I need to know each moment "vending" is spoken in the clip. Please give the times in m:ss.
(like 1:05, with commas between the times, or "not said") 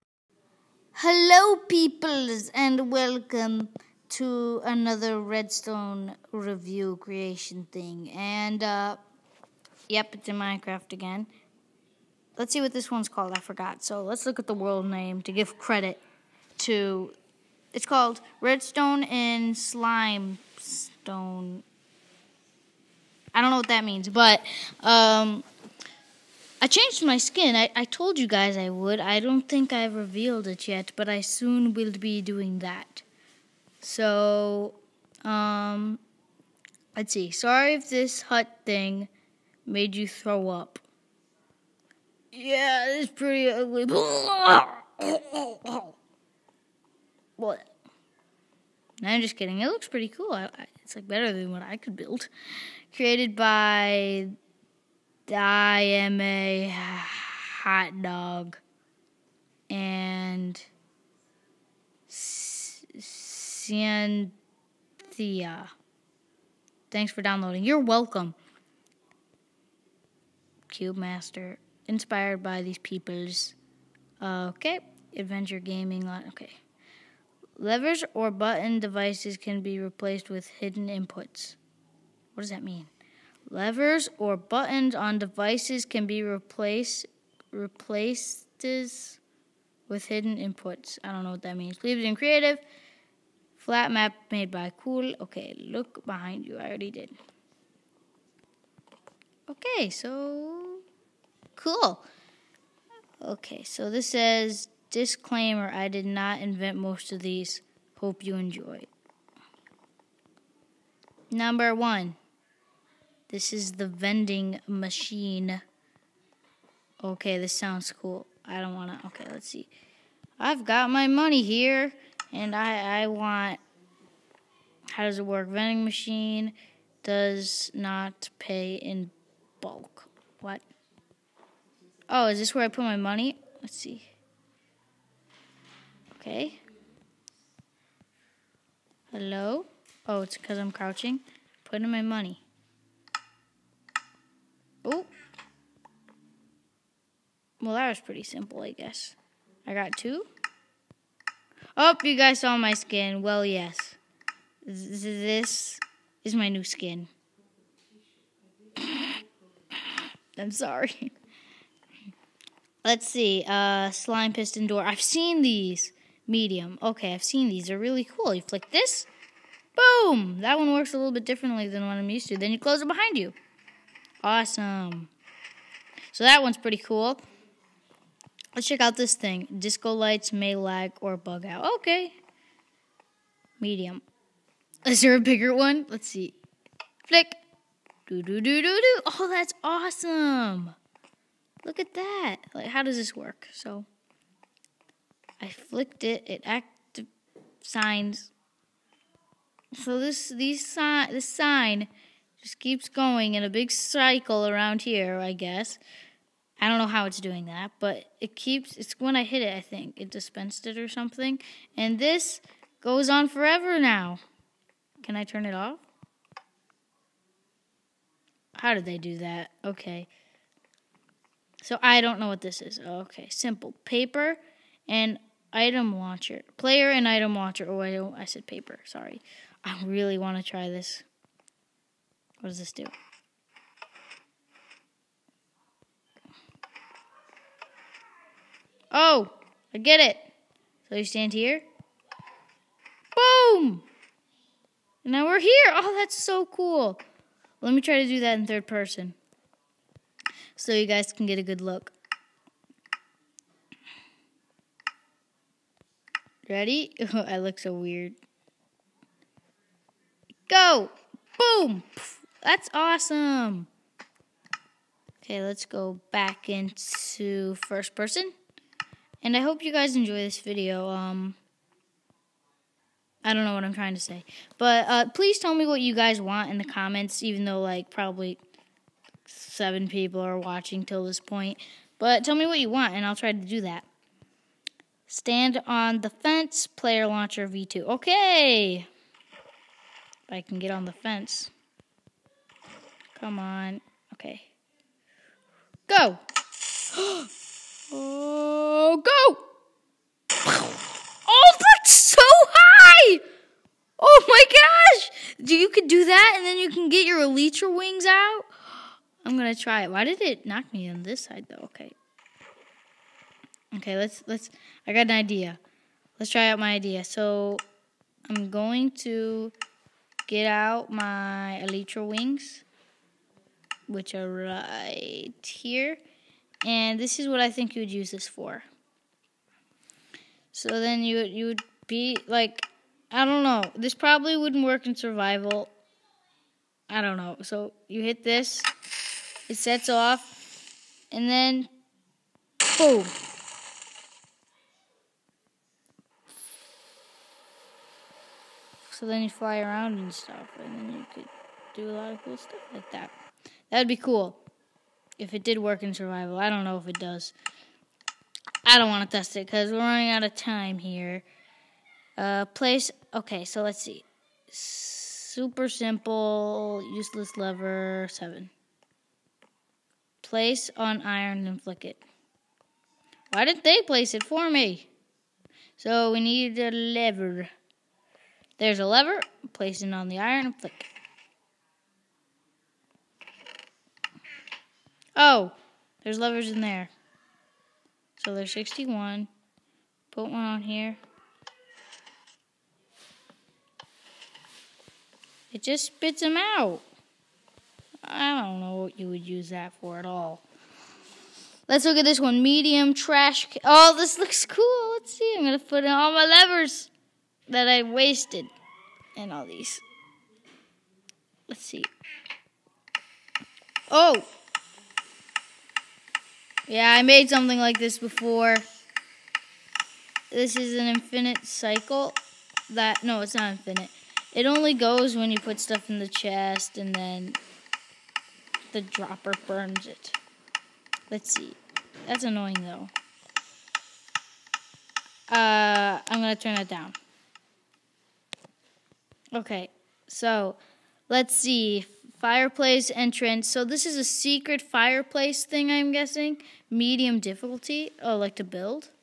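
1:53, 2:05.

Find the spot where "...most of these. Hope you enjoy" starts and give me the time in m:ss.
1:46.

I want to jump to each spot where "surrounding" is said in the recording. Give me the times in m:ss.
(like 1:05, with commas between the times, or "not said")
not said.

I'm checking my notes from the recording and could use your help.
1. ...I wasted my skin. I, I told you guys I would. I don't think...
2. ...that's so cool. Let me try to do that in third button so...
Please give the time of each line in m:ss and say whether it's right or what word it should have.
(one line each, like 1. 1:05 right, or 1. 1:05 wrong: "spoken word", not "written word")
1. 0:26 wrong: "changed", not "wasted"
2. 4:05 wrong: "person", not "button".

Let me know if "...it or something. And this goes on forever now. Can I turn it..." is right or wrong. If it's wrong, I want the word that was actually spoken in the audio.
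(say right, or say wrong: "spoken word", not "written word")
right.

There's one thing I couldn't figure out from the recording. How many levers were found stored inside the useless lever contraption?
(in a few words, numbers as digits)
61.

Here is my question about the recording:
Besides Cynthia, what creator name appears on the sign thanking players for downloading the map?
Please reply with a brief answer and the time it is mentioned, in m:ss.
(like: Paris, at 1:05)
I am a hot dog, at 0:55.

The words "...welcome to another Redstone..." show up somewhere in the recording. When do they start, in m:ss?
0:02.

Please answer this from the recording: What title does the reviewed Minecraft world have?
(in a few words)
Redstone and slime stone.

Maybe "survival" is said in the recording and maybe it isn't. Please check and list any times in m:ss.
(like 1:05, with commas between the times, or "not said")
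5:34, 5:55.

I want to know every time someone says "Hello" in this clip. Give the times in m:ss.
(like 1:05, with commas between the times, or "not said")
0:01, 2:19.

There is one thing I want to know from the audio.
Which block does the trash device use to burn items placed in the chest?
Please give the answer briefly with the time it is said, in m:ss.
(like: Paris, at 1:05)
the dropper, at 7:08.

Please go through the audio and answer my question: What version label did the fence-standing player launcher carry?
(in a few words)
V2.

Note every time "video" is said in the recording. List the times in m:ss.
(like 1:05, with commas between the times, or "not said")
4:30.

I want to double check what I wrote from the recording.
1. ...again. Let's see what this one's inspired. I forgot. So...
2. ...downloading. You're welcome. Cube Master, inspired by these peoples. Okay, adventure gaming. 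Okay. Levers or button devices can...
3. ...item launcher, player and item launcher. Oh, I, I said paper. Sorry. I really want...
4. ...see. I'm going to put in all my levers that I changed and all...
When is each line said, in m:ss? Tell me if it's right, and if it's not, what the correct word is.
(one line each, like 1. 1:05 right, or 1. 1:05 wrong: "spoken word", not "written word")
1. 0:10 wrong: "called", not "inspired"
2. 1:07 right
3. 3:45 right
4. 6:45 wrong: "wasted", not "changed".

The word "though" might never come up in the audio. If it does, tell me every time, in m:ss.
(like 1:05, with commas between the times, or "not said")
4:37, 5:11, 7:12.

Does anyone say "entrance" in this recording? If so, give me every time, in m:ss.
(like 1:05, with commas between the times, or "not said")
7:22.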